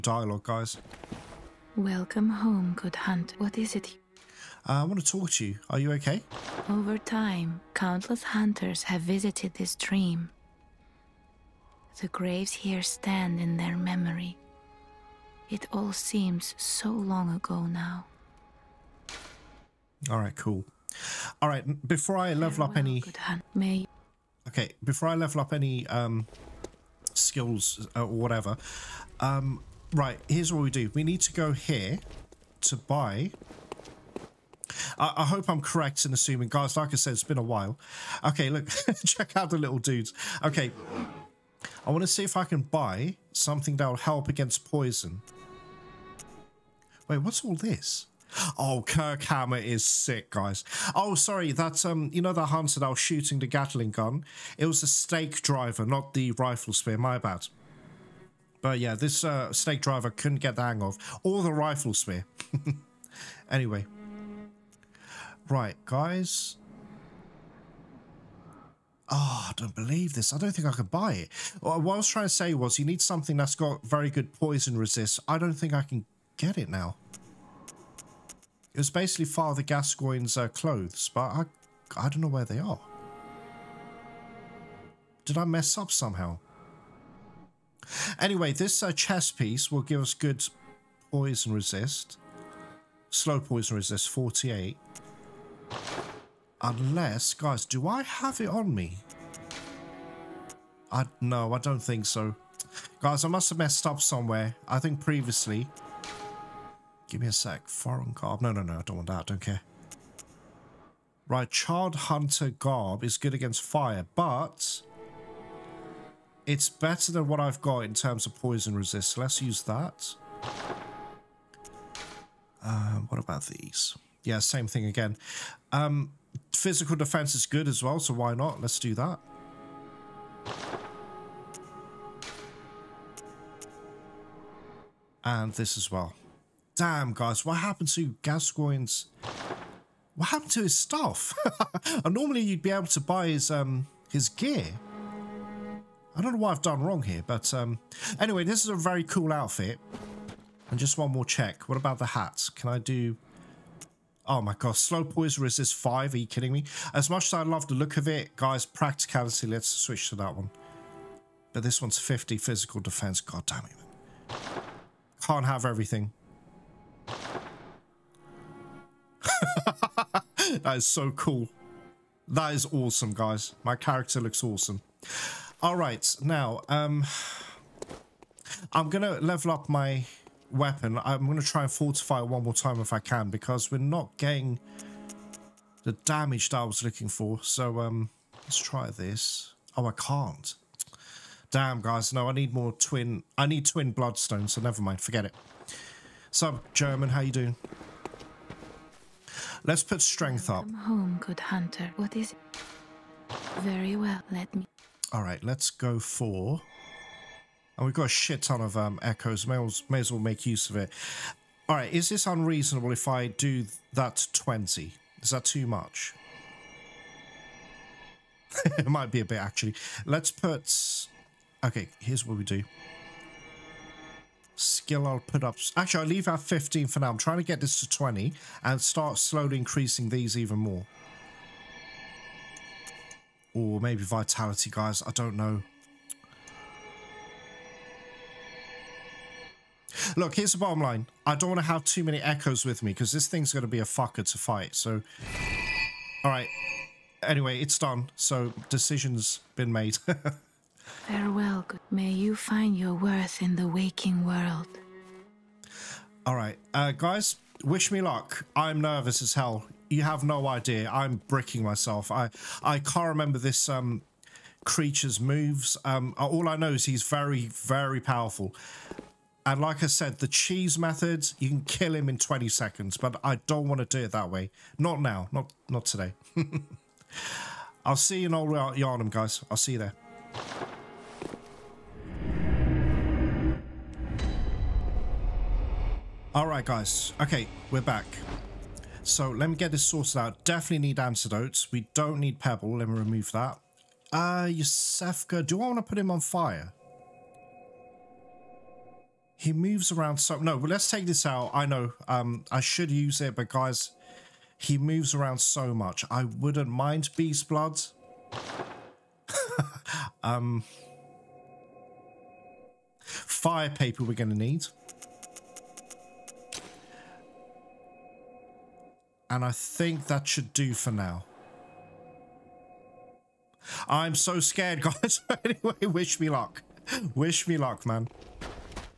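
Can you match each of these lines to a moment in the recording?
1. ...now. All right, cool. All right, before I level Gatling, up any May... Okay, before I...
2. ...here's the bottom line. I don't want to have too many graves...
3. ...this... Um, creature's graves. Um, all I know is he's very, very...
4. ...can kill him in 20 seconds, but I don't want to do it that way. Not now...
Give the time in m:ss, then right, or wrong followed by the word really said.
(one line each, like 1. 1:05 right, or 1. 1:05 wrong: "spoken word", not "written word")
1. 0:17 wrong: "Farewell", not "Gatling"
2. 4:00 wrong: "echoes", not "graves"
3. 4:23 wrong: "moves", not "graves"
4. 4:31 right.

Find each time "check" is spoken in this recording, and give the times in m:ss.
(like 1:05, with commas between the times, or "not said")
0:39, 2:31.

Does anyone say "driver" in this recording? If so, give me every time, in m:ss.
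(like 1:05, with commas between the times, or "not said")
0:55, 0:59.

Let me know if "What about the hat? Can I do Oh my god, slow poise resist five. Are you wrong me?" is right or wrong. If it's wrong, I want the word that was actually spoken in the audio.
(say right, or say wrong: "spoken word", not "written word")
wrong: "kidding", not "wrong".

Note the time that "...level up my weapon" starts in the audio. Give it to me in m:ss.
2:59.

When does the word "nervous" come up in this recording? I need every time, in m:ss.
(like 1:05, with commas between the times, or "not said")
4:18.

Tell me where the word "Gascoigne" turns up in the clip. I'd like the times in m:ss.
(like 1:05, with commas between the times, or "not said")
1:19, 2:18.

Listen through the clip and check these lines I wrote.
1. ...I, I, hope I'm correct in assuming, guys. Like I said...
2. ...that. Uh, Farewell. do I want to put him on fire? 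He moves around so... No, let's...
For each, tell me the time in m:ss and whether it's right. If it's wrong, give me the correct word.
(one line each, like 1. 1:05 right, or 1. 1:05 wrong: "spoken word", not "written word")
1. 0:34 right
2. 4:53 wrong: "Iosefka", not "Farewell".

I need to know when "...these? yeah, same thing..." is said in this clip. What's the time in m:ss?
2:03.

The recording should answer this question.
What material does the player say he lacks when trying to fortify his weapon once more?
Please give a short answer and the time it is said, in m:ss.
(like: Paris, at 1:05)
Twin bloodstone, at 3:13.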